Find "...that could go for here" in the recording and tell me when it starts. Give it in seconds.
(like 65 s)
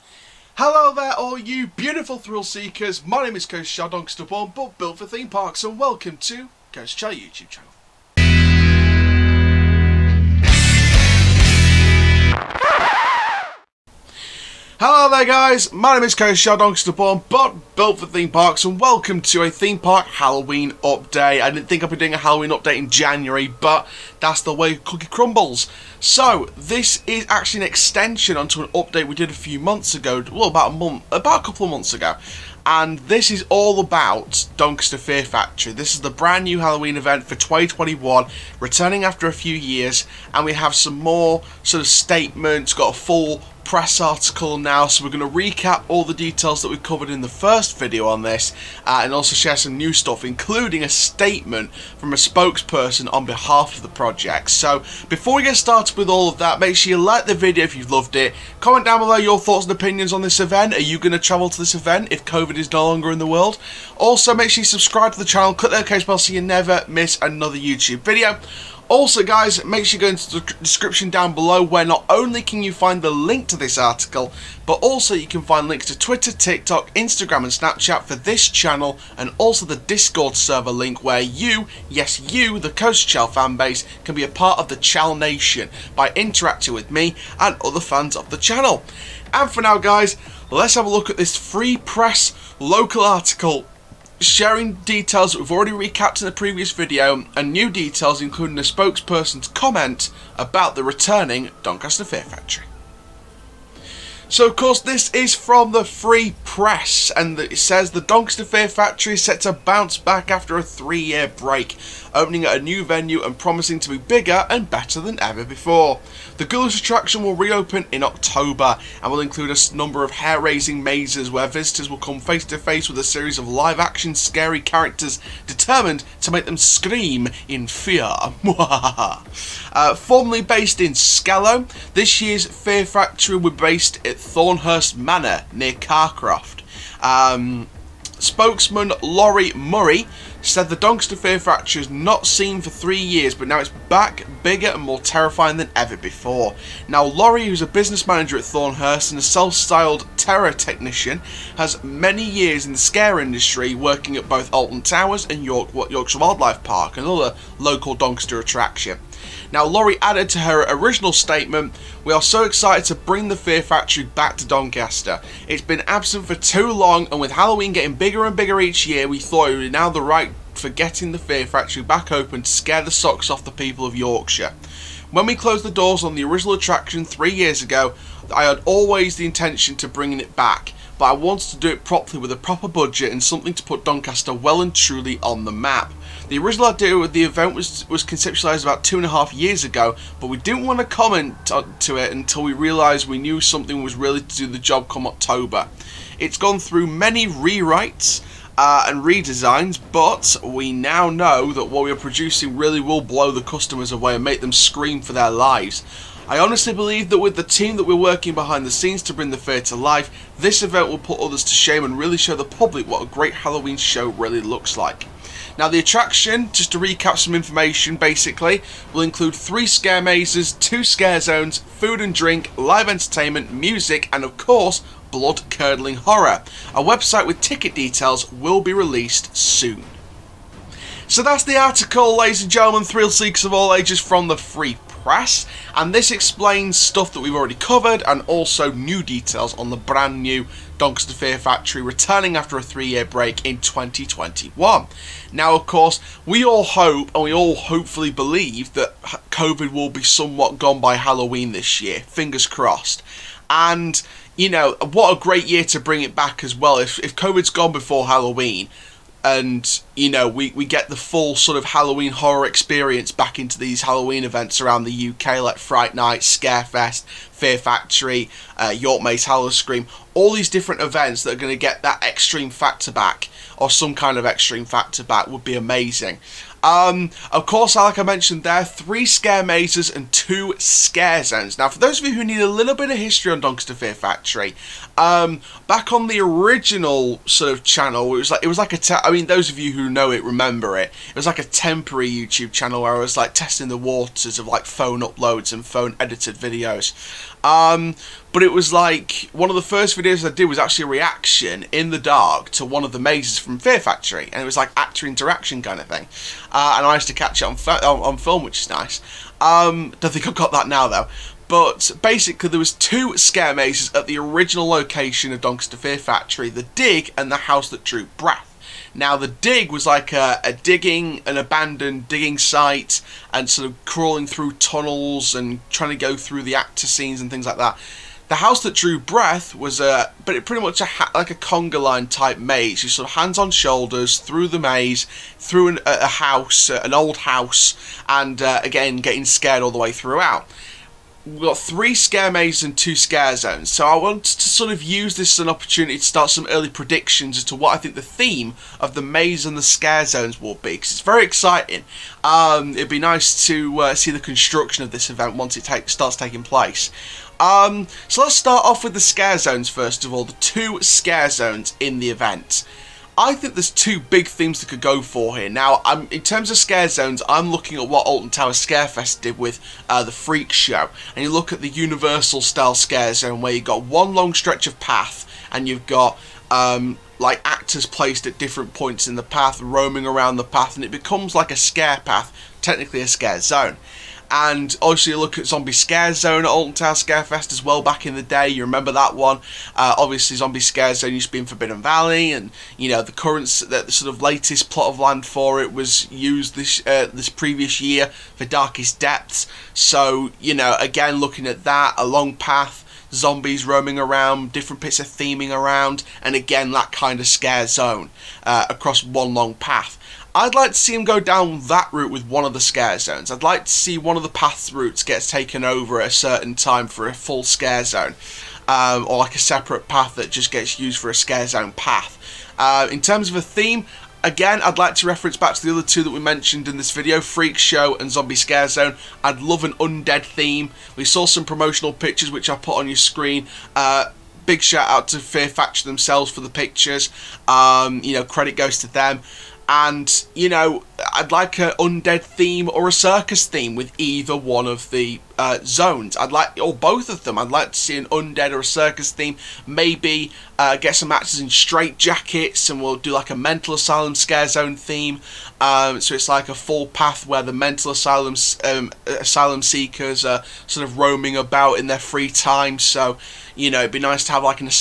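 364 s.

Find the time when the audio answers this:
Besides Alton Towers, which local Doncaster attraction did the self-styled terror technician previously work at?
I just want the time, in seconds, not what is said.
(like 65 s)
155 s.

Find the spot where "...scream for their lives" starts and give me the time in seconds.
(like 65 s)
204 s.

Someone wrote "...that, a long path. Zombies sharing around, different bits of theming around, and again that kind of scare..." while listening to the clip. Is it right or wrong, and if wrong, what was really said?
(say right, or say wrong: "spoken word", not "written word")
wrong: "roaming", not "sharing".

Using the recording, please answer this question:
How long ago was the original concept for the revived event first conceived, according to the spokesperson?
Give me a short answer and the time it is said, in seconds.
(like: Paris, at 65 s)
2.5 years, at 188 s.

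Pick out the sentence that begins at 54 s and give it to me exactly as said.
So before we get started with all of that, make sure you like the video if you've loved it.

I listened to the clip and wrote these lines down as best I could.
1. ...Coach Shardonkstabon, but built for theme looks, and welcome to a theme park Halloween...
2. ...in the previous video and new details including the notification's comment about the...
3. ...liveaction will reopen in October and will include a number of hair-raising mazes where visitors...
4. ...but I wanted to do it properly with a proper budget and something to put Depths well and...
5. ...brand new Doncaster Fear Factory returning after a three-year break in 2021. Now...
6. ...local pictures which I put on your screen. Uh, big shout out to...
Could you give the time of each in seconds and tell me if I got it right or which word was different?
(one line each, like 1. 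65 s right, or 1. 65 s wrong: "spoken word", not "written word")
1. 16 s wrong: "parks", not "looks"
2. 96 s wrong: "spokesperson", not "notification"
3. 116 s wrong: "attraction", not "liveaction"
4. 180 s wrong: "Doncaster", not "Depths"
5. 239 s right
6. 431 s wrong: "promotional", not "local".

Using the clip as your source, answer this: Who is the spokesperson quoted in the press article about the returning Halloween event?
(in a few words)
Laurie Murray.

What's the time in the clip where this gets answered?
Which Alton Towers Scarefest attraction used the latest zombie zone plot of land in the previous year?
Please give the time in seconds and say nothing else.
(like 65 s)
398 s.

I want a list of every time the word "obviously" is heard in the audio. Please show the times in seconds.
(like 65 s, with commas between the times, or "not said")
384 s, 389 s.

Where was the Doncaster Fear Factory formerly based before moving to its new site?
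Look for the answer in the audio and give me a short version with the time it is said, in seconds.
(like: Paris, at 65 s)
Skellow, at 130 s.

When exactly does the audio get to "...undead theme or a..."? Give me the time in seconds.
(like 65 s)
441 s.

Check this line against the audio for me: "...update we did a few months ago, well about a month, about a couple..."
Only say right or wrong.
right.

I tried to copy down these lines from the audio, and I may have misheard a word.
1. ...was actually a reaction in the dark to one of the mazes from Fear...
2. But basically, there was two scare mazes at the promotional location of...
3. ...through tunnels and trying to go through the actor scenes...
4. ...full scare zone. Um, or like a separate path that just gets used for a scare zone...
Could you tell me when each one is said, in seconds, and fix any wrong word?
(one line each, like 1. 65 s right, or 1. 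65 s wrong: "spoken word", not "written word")
1. 300 s right
2. 311 s wrong: "original", not "promotional"
3. 324 s right
4. 417 s right.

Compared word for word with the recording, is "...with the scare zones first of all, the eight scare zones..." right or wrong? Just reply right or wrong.
wrong.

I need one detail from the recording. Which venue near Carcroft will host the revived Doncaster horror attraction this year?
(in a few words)
Thornhurst Manor.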